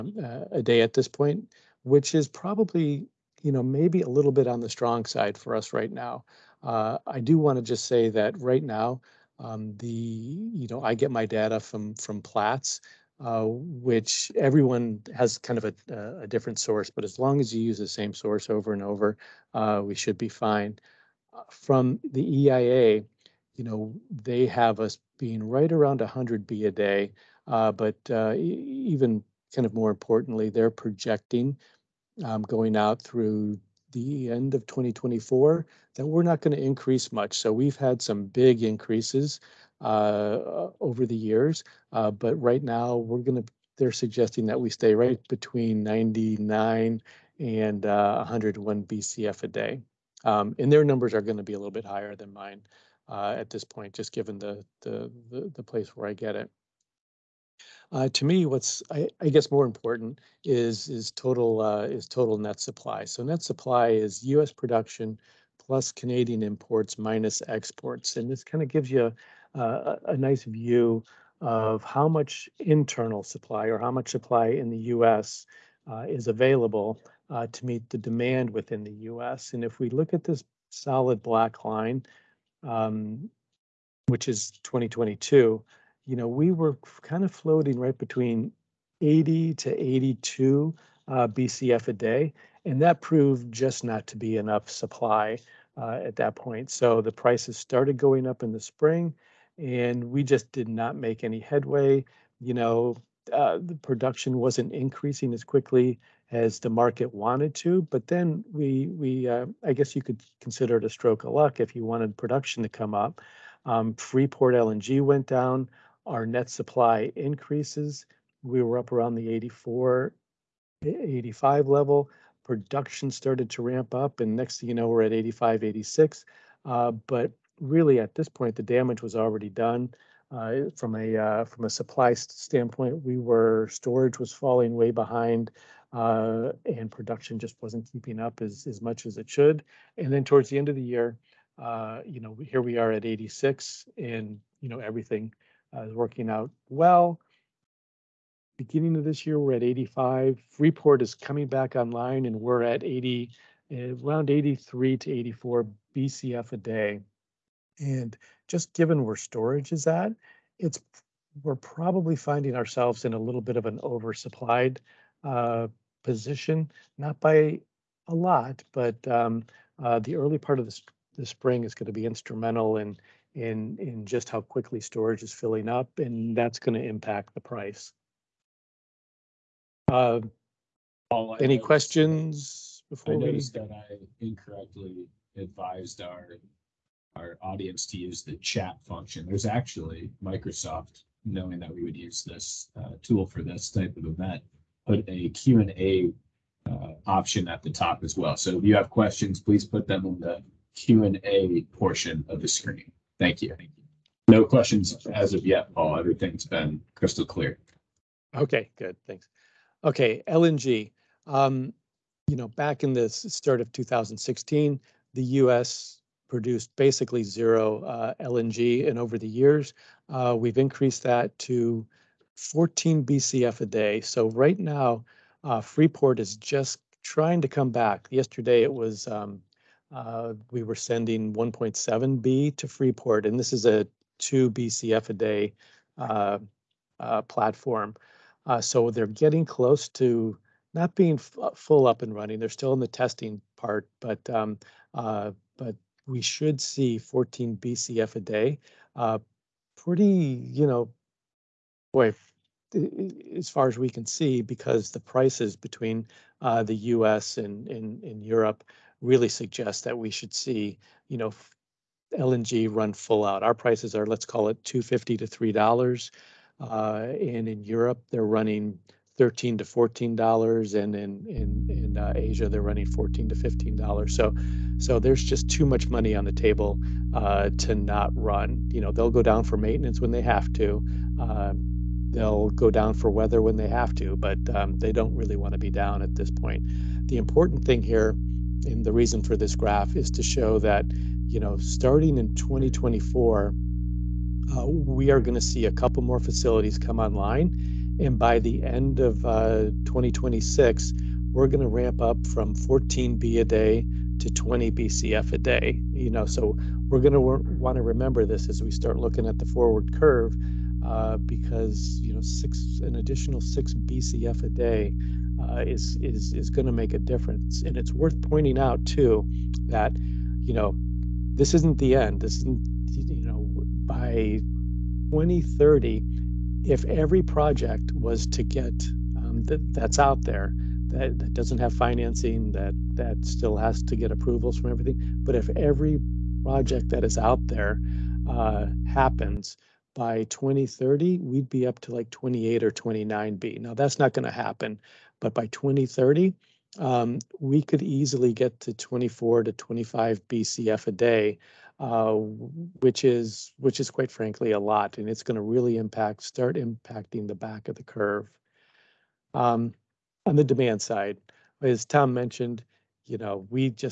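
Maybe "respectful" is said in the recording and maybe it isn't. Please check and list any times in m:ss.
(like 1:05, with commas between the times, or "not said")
not said.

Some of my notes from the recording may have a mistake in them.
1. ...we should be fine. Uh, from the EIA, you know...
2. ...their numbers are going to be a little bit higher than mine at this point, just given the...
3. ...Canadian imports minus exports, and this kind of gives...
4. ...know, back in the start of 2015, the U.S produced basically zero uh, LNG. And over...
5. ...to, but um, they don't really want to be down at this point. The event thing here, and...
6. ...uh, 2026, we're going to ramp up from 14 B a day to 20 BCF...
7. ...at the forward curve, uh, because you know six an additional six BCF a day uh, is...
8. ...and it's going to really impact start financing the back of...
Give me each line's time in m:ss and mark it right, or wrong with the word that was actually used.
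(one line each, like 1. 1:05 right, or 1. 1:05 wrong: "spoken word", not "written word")
1. 0:19 right
2. 0:50 right
3. 1:05 right
4. 3:32 wrong: "2016", not "2015"
5. 4:43 wrong: "important", not "event"
6. 4:59 right
7. 5:09 right
8. 5:54 wrong: "impacting", not "financing".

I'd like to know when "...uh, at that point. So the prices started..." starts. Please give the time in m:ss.
1:35.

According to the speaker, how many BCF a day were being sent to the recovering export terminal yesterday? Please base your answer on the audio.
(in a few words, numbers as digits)
1.7.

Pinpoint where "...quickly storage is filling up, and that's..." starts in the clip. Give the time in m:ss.
2:54.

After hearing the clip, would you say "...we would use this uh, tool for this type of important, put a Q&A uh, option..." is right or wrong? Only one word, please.
wrong.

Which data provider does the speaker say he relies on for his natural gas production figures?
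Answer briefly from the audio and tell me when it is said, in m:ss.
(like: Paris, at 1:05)
Platts, at 0:12.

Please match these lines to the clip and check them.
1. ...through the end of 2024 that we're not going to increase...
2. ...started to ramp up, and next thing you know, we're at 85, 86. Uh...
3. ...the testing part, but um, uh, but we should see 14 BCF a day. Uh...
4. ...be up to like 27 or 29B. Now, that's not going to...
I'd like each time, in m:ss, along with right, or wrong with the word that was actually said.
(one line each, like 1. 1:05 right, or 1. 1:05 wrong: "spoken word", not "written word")
1. 0:32 right
2. 2:03 right
3. 4:02 right
4. 5:41 wrong: "28", not "27".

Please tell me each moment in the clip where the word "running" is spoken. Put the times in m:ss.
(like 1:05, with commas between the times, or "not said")
4:02, 4:28, 4:32.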